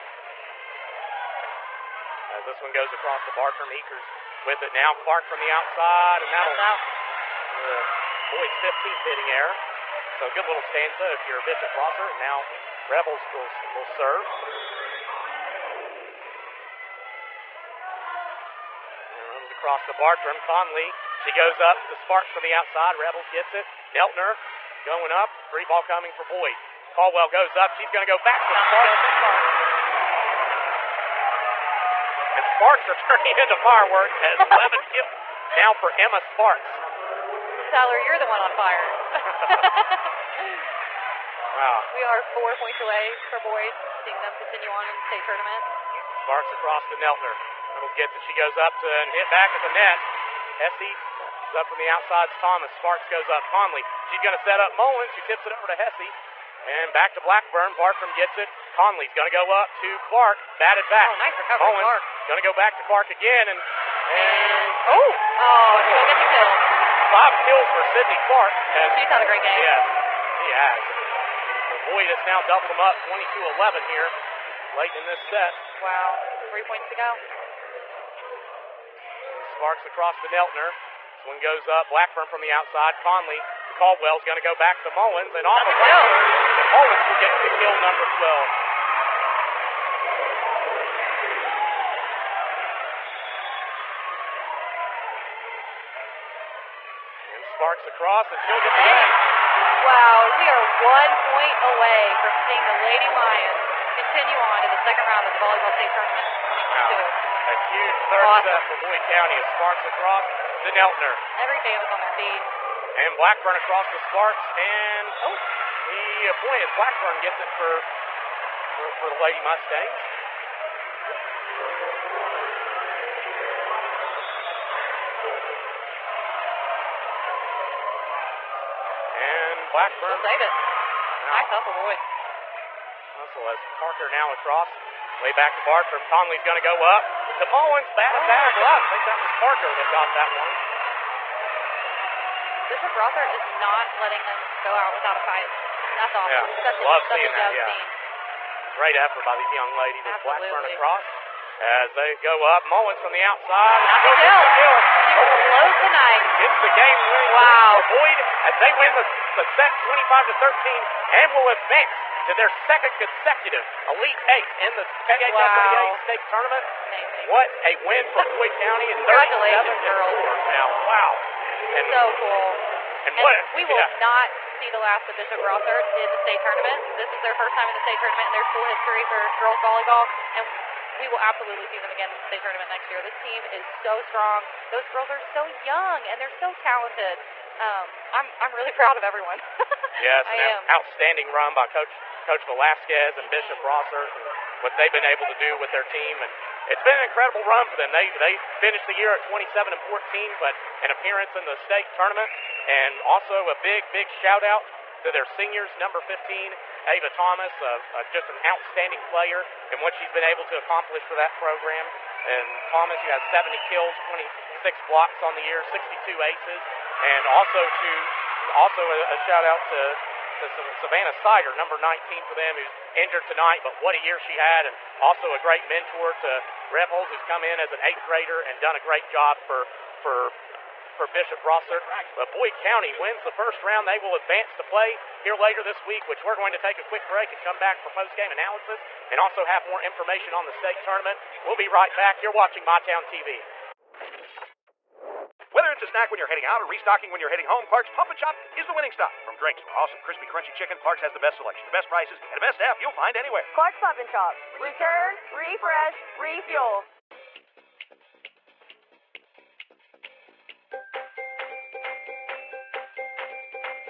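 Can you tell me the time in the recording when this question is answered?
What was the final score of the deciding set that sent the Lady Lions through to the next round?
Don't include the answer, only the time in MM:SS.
02:39.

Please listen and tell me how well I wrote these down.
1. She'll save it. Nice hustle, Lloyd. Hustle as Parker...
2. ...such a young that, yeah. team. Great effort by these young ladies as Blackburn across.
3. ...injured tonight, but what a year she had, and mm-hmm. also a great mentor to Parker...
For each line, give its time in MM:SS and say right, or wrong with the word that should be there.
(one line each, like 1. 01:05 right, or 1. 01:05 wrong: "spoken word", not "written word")
1. 02:10 right
2. 02:27 right
3. 03:42 wrong: "Rebholz", not "Parker".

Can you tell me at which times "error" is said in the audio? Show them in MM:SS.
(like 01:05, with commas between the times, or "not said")
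00:09.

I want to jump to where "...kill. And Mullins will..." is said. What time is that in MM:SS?
01:25.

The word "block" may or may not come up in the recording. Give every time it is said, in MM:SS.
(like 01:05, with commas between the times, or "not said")
02:18, 03:34.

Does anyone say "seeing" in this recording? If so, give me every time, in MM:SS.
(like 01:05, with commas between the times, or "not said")
00:44, 01:42.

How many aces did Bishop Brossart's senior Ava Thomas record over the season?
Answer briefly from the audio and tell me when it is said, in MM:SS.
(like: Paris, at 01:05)
62, at 03:35.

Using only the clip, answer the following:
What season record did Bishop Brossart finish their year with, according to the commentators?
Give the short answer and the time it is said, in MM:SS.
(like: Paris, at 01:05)
27-14, at 03:19.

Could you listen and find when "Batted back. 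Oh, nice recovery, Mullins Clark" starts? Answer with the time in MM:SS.
01:00.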